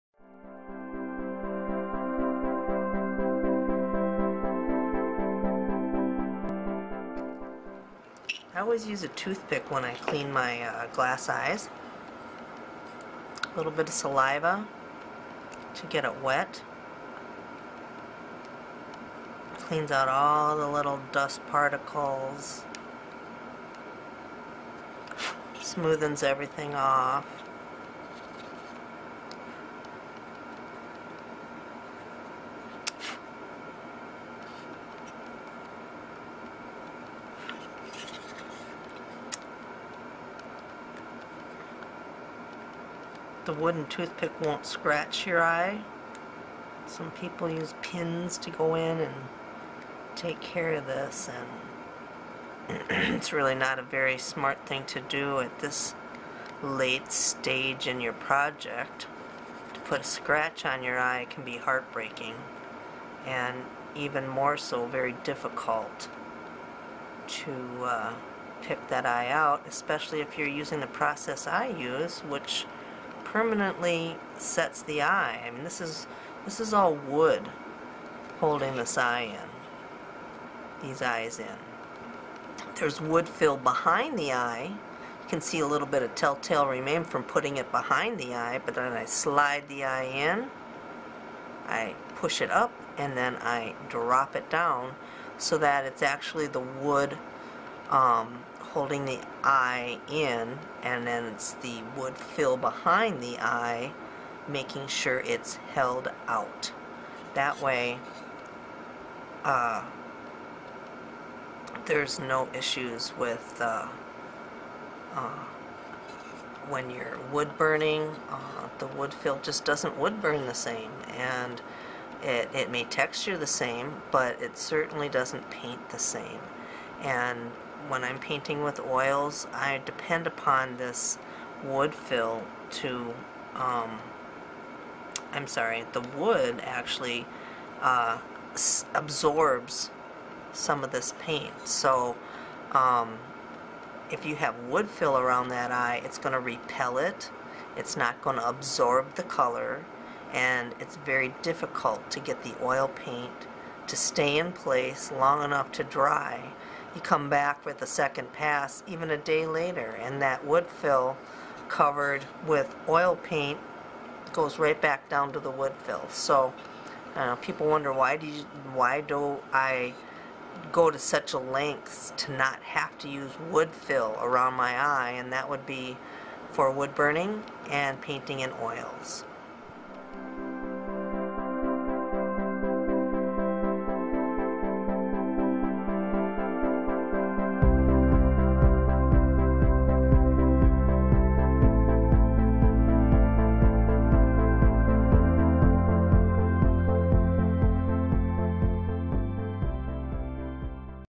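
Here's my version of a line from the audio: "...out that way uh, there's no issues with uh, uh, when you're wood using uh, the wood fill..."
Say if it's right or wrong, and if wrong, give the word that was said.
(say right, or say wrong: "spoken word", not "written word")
wrong: "burning", not "using".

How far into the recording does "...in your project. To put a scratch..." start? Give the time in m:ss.
0:57.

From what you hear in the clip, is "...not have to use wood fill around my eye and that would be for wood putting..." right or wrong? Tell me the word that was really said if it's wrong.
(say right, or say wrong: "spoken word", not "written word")
wrong: "burning", not "putting".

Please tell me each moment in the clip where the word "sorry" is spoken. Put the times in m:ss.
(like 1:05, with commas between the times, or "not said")
2:15.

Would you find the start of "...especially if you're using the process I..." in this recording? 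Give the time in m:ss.
1:09.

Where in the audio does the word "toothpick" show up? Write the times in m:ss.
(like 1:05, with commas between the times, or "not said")
0:09, 0:43.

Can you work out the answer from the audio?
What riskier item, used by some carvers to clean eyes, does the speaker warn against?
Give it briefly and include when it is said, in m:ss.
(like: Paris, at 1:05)
pins, at 0:47.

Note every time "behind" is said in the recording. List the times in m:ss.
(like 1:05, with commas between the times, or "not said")
1:23, 1:27, 1:42.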